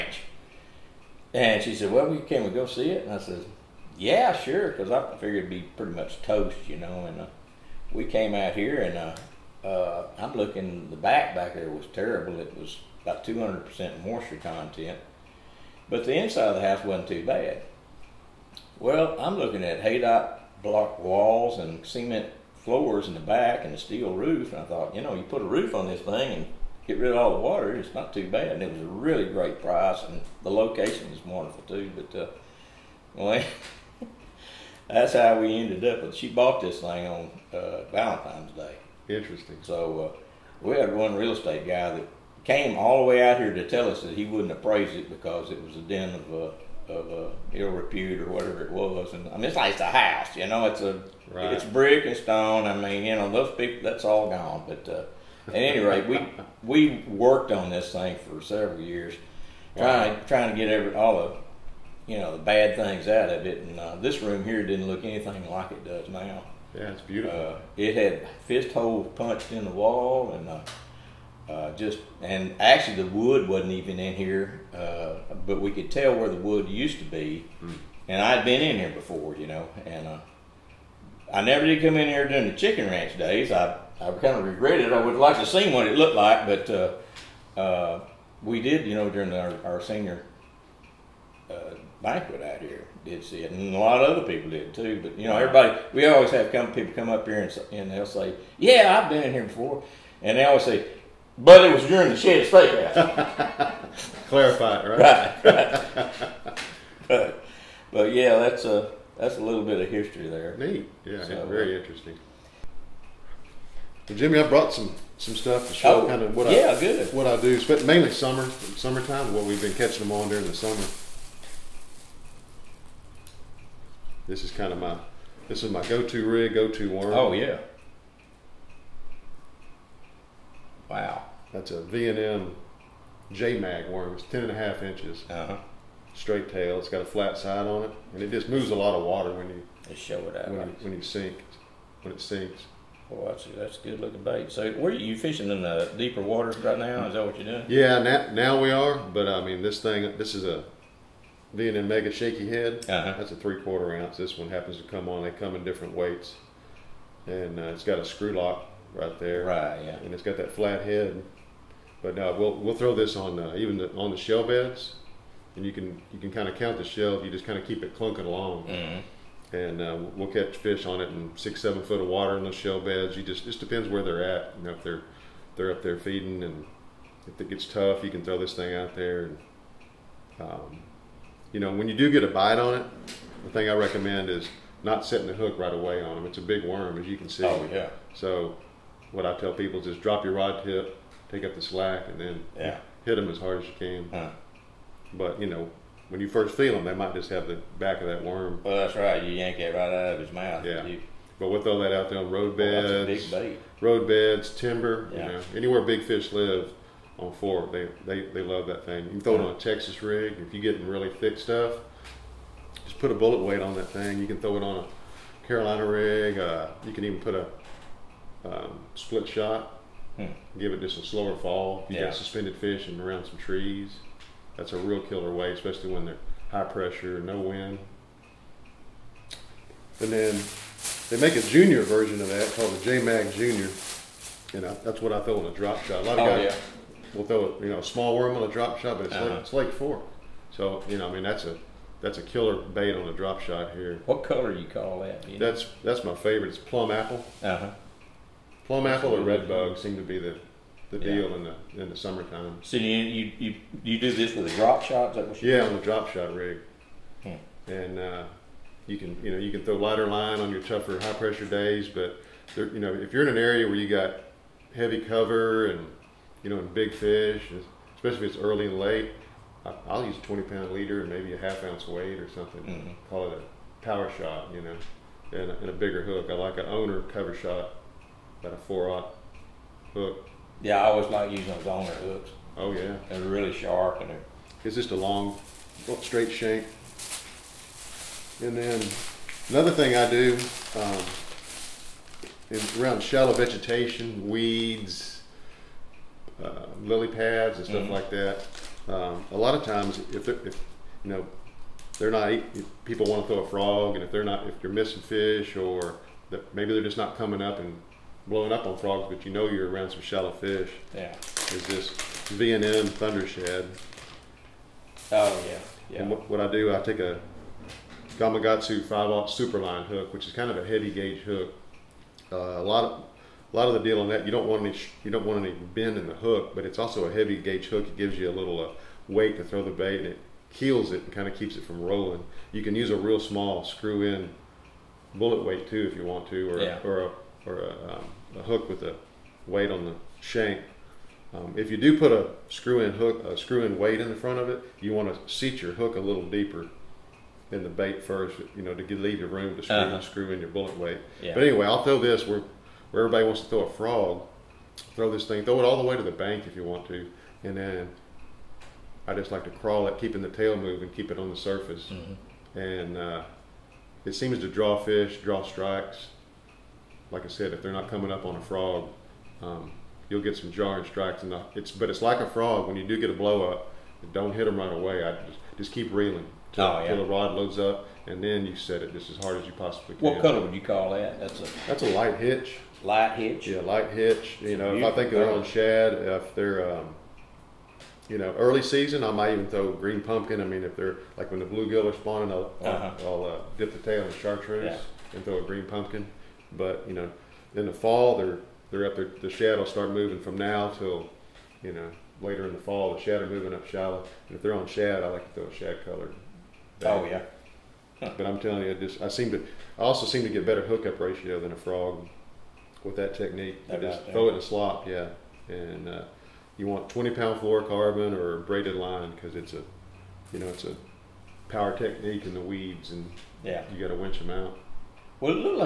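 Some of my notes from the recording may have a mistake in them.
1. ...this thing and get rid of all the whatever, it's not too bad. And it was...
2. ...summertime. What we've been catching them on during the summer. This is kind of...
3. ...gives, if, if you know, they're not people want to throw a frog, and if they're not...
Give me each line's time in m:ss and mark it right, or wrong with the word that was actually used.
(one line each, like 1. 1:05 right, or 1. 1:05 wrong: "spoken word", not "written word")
1. 0:25 wrong: "water", not "whatever"
2. 1:58 right
3. 4:59 wrong: "times", not "gives".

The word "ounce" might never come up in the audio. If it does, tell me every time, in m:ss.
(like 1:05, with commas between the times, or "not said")
2:33, 4:31.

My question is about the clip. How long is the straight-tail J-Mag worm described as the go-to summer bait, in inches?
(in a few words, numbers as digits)
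10.5.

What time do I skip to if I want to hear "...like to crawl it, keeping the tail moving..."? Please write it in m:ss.
5:59.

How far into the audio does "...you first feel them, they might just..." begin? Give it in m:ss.
3:16.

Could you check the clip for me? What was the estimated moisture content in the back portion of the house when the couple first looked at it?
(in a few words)
200%.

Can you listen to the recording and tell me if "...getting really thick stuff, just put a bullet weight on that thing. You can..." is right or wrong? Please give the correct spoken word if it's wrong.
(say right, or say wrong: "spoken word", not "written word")
right.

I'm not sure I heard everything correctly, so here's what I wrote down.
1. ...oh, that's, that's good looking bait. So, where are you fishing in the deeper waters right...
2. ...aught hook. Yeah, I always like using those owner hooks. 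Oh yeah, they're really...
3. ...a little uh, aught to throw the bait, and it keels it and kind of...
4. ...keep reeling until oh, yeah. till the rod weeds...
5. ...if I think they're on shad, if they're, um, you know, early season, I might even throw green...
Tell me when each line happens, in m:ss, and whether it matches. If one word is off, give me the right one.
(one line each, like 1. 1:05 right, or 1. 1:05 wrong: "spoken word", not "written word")
1. 2:23 right
2. 4:38 right
3. 5:28 wrong: "weight", not "aught"
4. 6:15 wrong: "loads", not "weeds"
5. 6:24 right.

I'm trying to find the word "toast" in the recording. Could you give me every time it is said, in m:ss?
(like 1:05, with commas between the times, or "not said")
0:06.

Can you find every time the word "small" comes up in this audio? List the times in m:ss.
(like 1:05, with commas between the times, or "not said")
3:57, 5:33.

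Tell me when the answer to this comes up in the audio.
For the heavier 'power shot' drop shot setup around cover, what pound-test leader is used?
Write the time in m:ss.
4:30.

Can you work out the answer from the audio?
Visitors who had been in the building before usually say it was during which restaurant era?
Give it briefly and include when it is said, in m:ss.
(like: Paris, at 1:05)
the shed steakhouse, at 1:42.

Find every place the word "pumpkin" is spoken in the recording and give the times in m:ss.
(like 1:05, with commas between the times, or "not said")
6:30, 6:35.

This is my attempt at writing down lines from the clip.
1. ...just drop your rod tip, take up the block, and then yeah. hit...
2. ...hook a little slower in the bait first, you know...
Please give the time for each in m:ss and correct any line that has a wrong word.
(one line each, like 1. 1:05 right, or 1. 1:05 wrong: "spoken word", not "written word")
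1. 3:09 wrong: "slack", not "block"
2. 5:45 wrong: "deeper", not "slower".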